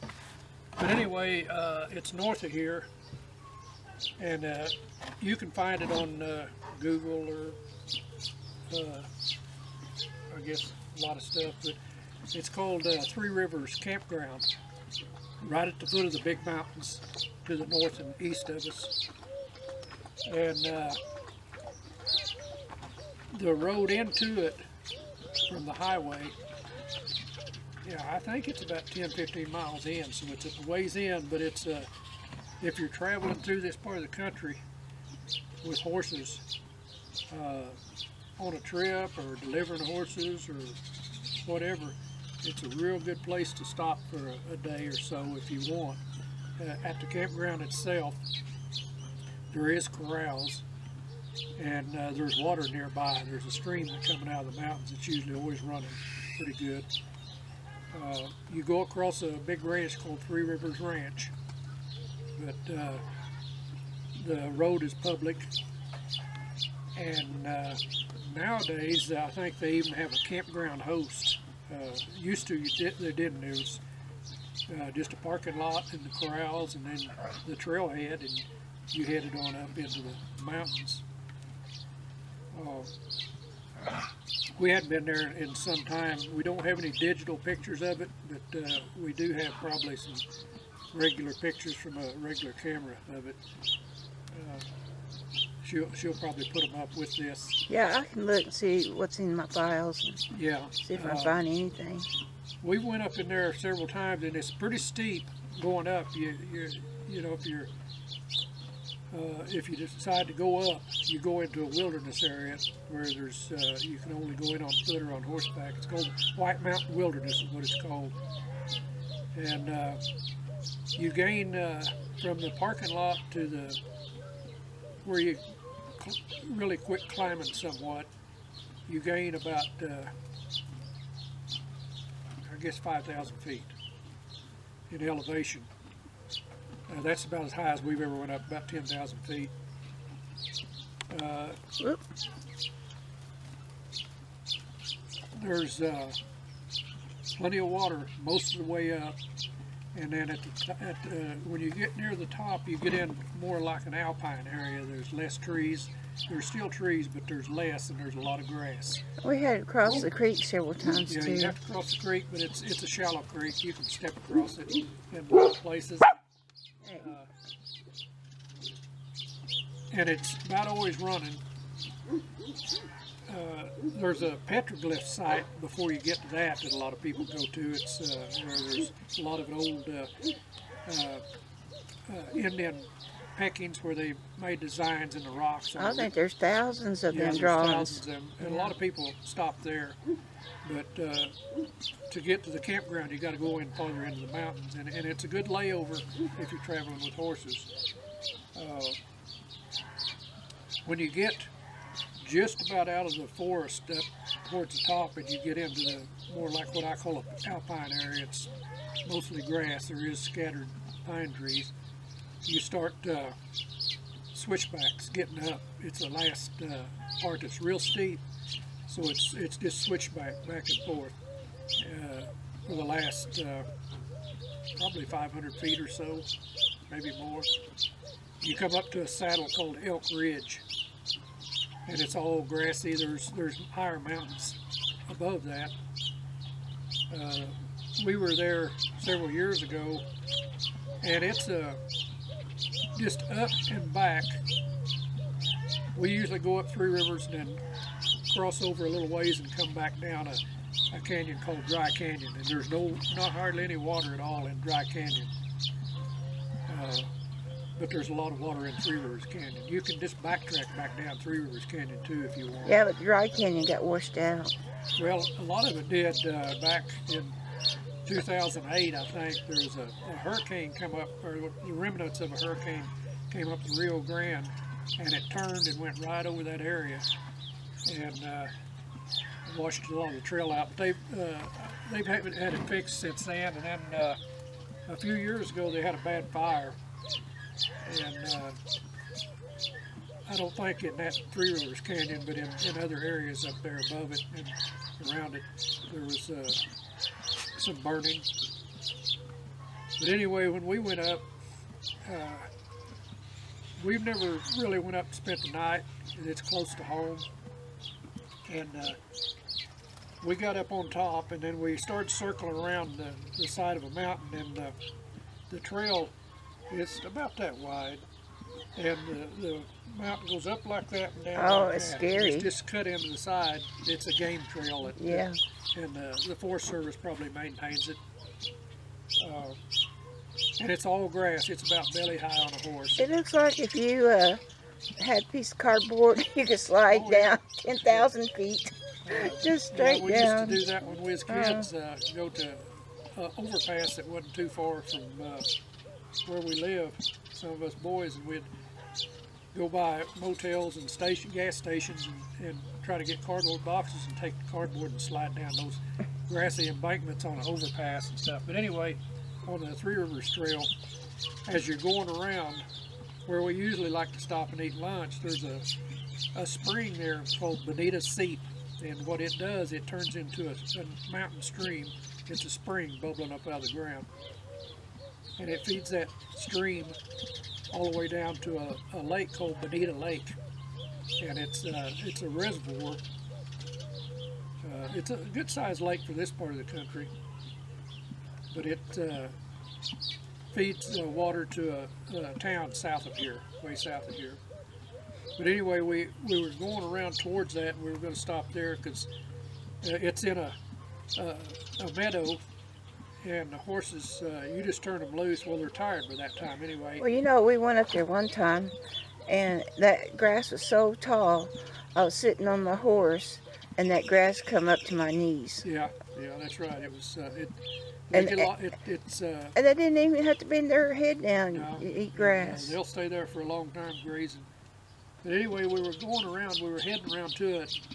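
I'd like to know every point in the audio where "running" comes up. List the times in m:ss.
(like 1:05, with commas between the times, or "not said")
0:55, 2:50.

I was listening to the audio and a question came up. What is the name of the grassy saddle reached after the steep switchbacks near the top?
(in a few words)
Elk Ridge.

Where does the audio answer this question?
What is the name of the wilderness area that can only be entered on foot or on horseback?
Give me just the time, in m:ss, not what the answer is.
1:56.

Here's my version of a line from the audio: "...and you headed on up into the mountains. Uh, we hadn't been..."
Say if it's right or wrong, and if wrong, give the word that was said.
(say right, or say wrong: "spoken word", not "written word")
right.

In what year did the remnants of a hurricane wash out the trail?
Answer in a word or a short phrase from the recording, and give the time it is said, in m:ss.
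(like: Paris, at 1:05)
2008, at 4:28.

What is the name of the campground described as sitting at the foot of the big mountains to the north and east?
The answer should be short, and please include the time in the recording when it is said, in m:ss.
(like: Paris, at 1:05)
Three Rivers Campground, at 0:13.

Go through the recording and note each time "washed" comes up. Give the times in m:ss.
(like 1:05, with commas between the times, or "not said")
4:23, 4:39.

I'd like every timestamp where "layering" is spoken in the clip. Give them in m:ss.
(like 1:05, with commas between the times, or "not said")
not said.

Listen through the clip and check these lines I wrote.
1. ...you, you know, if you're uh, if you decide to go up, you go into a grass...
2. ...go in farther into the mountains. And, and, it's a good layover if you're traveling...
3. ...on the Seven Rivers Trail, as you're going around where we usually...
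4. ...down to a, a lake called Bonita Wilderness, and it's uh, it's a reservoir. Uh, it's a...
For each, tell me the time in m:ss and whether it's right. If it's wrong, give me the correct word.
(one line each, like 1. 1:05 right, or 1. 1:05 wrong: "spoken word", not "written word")
1. 1:46 wrong: "wilderness", not "grass"
2. 3:13 right
3. 5:59 wrong: "Three", not "Seven"
4. 6:18 wrong: "Lake", not "Wilderness".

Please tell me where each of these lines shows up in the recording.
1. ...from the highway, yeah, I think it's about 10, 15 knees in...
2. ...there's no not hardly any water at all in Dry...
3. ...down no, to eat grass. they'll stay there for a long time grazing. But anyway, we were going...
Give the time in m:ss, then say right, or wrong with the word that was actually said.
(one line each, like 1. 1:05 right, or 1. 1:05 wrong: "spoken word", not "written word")
1. 0:25 wrong: "miles", not "knees"
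2. 4:12 right
3. 7:01 right.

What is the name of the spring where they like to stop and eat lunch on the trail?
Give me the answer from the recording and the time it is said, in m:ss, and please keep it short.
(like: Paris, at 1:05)
Bonita Seep, at 6:07.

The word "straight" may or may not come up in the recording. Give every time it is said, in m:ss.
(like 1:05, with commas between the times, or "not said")
5:39.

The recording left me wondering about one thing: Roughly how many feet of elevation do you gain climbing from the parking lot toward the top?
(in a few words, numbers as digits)
5,000 feet.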